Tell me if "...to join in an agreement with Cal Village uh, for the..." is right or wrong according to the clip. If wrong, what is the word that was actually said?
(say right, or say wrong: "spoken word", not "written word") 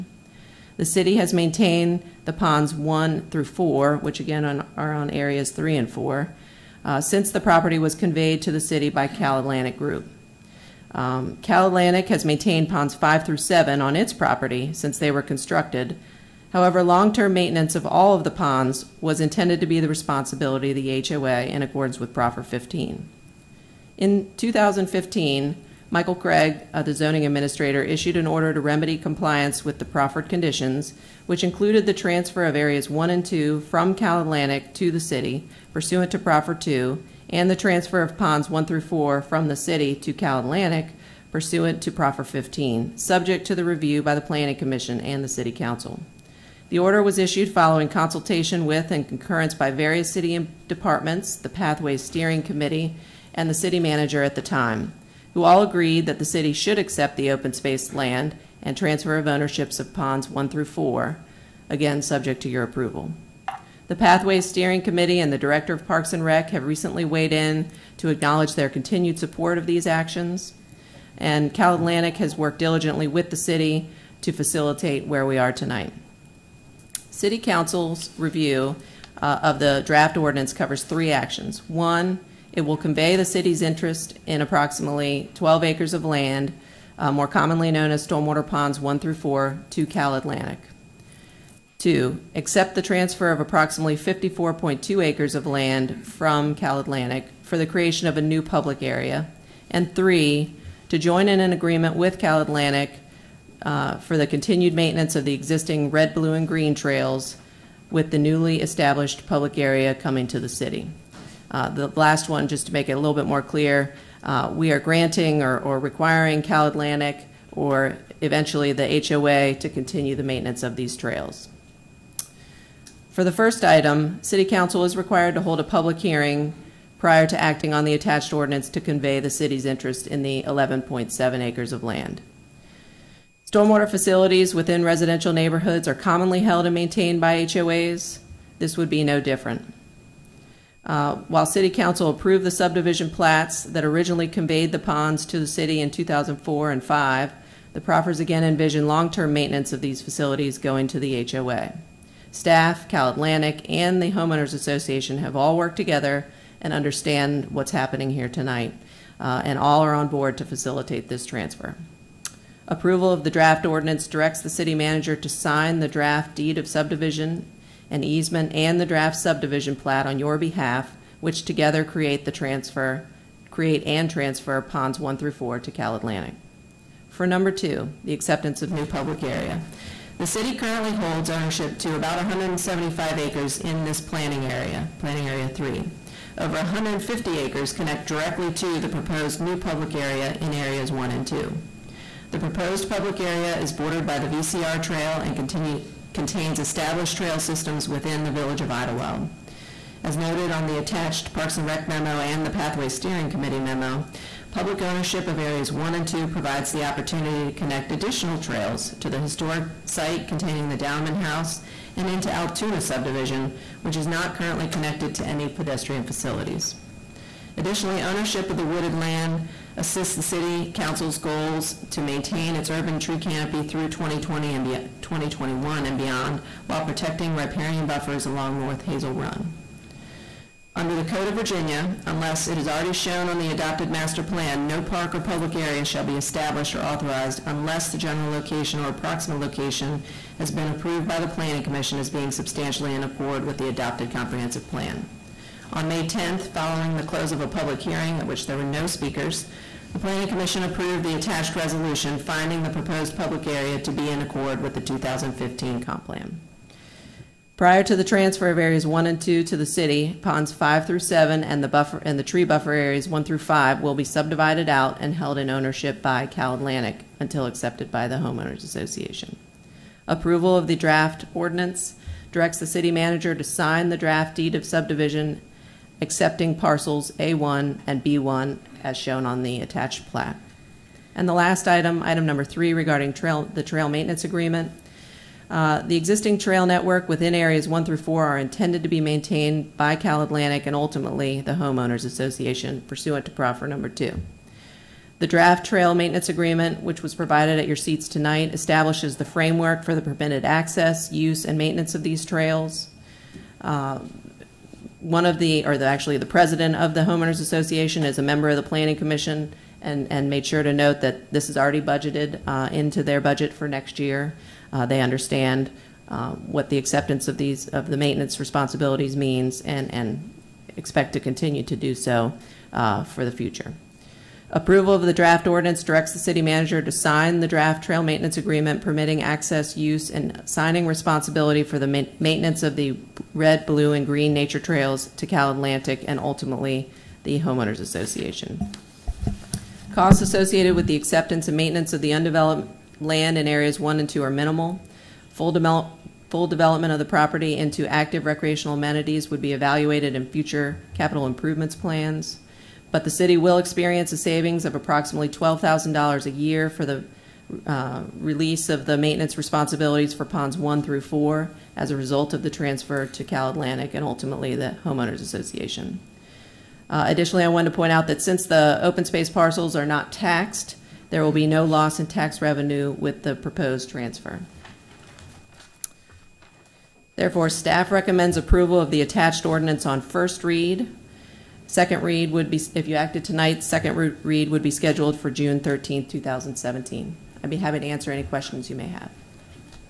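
wrong: "Atlantic", not "Village".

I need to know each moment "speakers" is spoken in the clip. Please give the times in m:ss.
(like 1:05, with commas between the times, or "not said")
4:08.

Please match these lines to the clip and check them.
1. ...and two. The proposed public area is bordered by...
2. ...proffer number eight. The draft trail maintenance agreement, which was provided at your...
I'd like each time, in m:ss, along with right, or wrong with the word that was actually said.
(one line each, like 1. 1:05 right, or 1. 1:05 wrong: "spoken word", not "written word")
1. 3:11 right
2. 4:53 wrong: "two", not "eight".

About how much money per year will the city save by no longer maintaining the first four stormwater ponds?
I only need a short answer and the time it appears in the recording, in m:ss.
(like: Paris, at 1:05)
$12,000, at 5:55.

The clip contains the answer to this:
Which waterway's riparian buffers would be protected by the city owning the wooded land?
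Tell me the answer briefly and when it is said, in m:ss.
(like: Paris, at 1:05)
North Hazel Run, at 3:48.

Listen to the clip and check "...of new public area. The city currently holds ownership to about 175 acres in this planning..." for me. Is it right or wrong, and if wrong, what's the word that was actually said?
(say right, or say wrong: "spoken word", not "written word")
right.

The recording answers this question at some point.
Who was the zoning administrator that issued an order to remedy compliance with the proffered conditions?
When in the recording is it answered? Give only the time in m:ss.
0:25.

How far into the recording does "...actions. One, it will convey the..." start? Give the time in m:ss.
1:21.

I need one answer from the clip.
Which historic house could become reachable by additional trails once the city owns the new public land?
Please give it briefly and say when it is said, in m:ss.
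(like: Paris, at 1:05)
Downman House, at 3:30.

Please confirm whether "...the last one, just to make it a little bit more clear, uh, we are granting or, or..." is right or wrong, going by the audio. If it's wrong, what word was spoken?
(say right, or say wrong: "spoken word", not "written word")
right.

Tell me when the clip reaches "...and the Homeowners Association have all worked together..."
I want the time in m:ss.
2:33.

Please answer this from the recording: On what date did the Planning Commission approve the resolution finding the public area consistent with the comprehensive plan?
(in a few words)
May 10.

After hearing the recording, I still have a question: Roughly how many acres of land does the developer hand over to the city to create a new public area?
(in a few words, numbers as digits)
54.2 acres.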